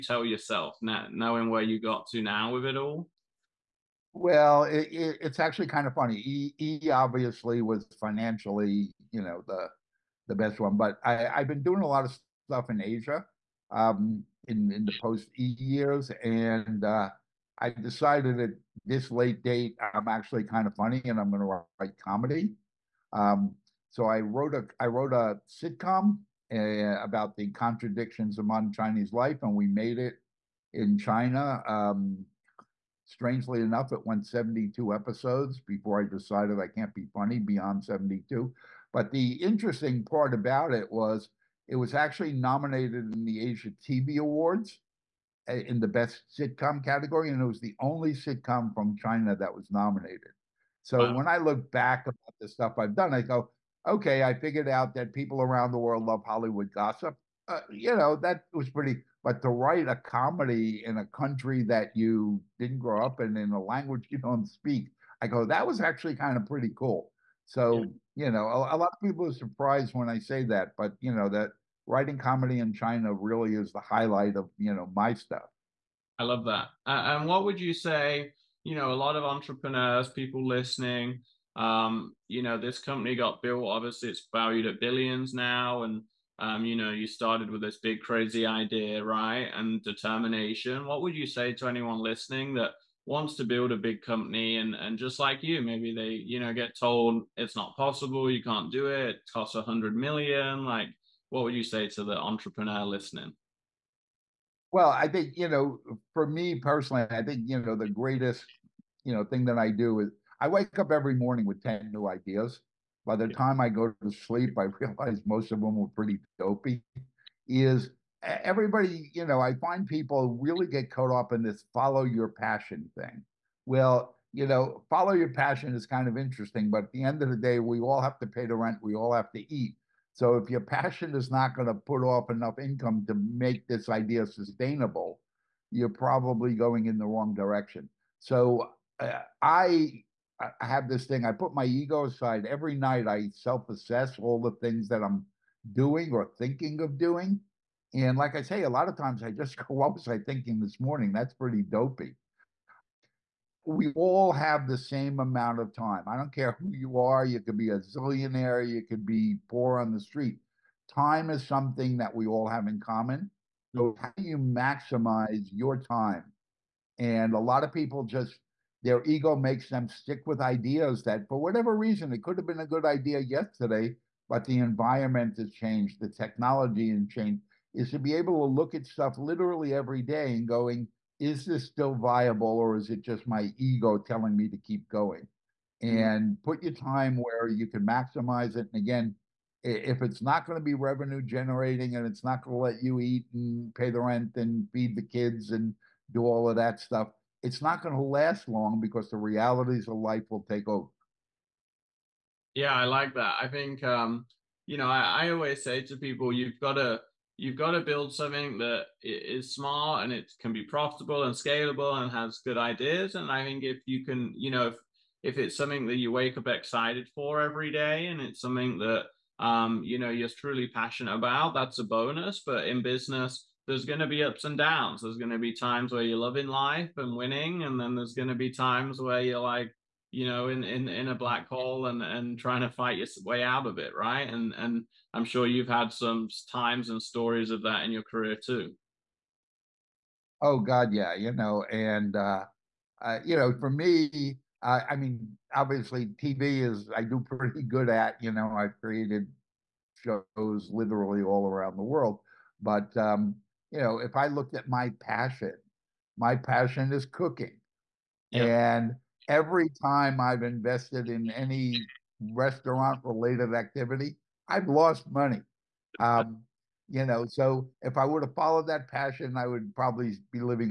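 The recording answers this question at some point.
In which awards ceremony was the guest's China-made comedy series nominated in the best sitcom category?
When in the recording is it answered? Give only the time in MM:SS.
00:43.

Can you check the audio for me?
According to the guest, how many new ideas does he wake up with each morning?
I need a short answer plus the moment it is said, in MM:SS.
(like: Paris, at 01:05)
10, at 01:51.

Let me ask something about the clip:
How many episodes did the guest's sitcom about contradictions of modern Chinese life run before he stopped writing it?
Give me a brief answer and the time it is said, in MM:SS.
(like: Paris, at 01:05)
72, at 00:34.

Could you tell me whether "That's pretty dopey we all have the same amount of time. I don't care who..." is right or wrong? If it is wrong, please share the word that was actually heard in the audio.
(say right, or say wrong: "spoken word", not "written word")
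right.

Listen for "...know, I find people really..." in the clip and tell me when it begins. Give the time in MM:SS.
01:59.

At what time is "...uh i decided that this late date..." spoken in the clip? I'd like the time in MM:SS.
00:16.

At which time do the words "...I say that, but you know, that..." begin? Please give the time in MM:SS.
01:10.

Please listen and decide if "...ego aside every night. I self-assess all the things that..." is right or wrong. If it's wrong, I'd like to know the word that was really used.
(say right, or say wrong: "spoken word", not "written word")
right.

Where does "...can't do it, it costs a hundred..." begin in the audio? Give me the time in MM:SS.
01:38.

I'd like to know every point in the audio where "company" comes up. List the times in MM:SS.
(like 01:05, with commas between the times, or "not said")
01:22, 01:34.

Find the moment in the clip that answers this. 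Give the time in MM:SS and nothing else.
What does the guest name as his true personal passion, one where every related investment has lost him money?
04:17.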